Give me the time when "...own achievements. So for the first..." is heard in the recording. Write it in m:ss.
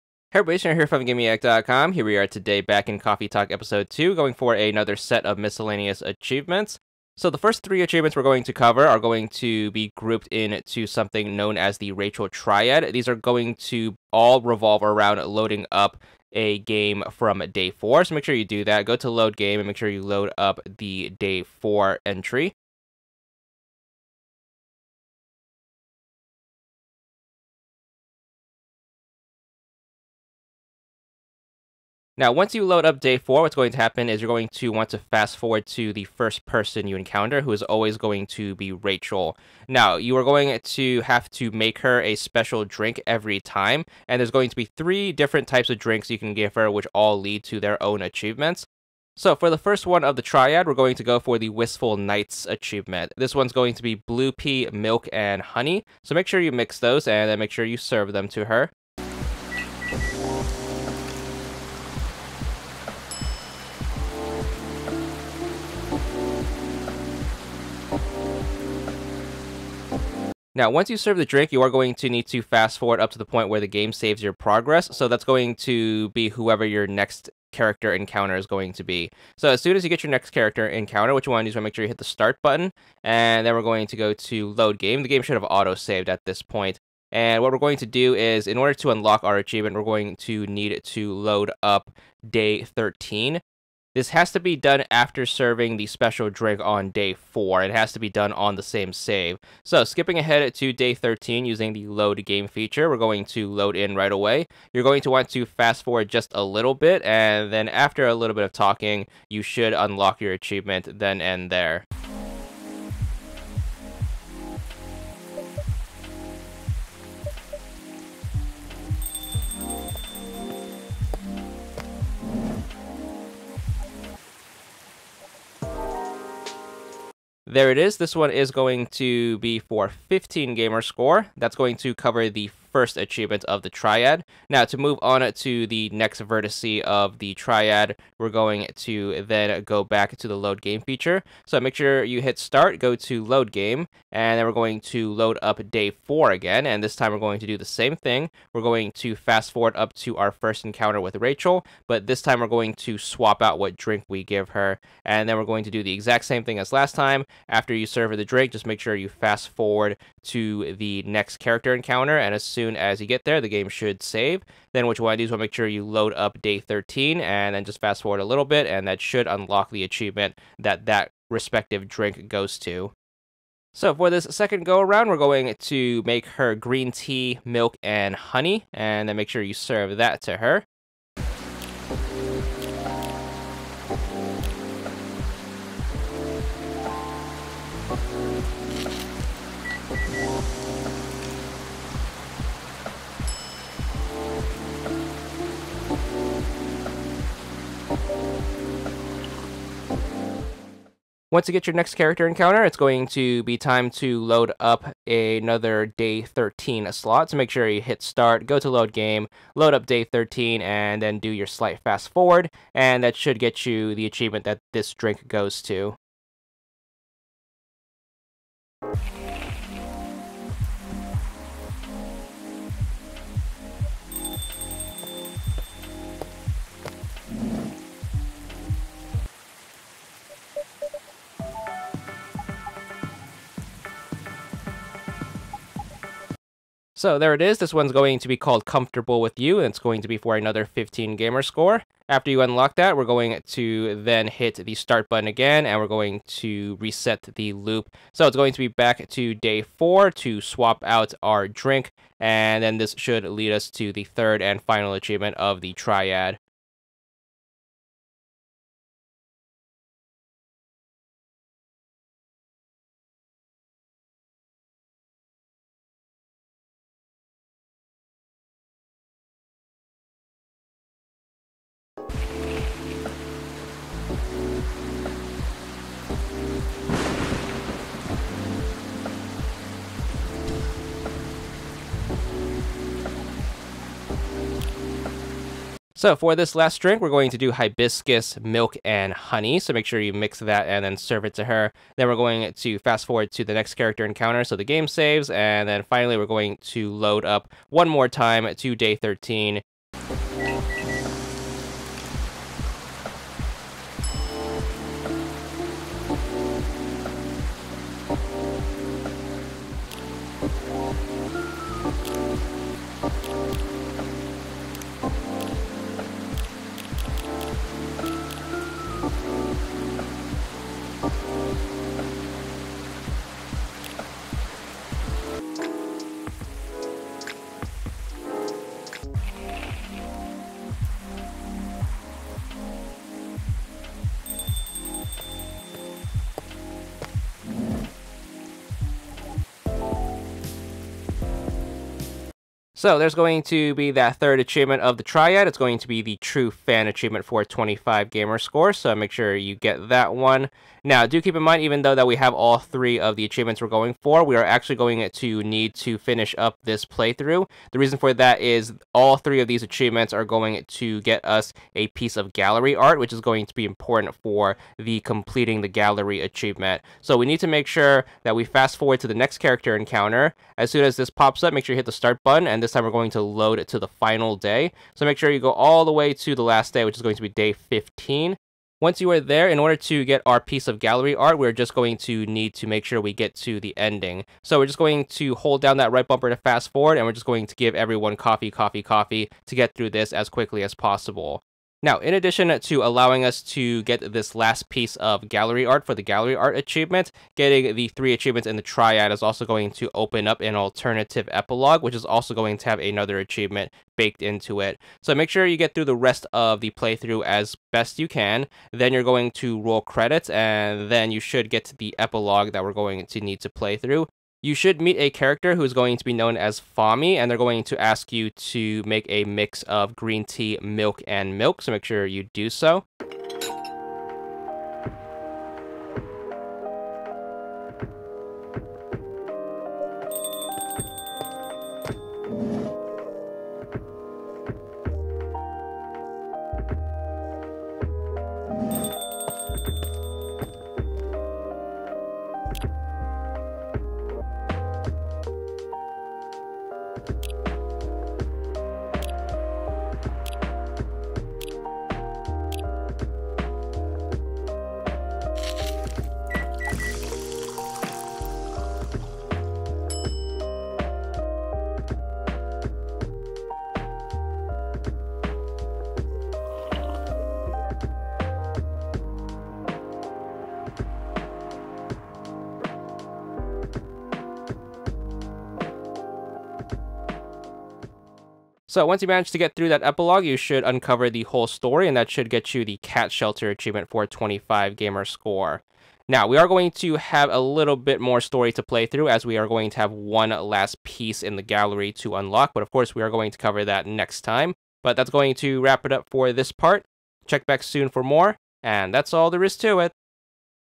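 0:47.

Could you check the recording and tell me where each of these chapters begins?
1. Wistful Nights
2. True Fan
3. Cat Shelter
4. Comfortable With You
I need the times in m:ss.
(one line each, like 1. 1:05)
1. 0:16
2. 4:09
3. 6:10
4. 2:20.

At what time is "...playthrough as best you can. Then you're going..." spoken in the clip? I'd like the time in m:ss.
6:46.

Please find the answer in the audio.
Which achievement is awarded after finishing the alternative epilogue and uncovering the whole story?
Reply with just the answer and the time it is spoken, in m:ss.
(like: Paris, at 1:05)
Cat Shelter, at 8:02.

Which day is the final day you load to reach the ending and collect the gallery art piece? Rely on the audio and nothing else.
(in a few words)
Day 15.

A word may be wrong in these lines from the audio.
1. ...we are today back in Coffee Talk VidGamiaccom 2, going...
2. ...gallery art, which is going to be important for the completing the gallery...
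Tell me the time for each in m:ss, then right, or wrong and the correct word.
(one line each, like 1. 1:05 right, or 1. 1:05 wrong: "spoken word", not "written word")
1. 0:02 wrong: "Episode", not "VidGamiaccom"
2. 6:02 right.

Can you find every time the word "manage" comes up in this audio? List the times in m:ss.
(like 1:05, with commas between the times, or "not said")
7:59.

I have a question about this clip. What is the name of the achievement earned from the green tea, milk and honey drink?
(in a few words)
Comfortable With You.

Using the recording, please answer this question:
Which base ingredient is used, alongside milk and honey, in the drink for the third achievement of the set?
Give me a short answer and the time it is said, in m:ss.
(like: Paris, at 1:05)
Hibiscus, at 4:47.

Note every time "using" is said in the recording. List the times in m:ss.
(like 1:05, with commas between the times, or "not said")
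1:41.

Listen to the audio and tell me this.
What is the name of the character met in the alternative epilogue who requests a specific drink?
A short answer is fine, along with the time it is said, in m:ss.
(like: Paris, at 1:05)
Fami, at 6:56.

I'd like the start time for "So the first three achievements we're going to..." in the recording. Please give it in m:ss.
0:07.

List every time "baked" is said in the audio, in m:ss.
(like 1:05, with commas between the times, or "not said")
6:43.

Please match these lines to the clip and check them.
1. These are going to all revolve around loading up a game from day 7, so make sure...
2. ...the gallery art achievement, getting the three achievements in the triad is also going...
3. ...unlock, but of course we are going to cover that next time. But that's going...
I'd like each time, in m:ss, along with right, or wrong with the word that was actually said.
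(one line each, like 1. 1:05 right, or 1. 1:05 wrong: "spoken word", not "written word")
1. 0:12 wrong: "4", not "7"
2. 6:35 right
3. 8:12 right.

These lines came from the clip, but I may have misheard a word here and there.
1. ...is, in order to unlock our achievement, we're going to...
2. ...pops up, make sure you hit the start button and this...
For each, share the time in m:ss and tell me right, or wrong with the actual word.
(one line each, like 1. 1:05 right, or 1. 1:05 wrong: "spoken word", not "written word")
1. 1:28 right
2. 6:11 right.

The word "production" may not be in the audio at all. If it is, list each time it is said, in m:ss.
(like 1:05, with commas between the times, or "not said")
not said.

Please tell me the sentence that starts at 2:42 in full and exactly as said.
And as soon as you get there, the game should save.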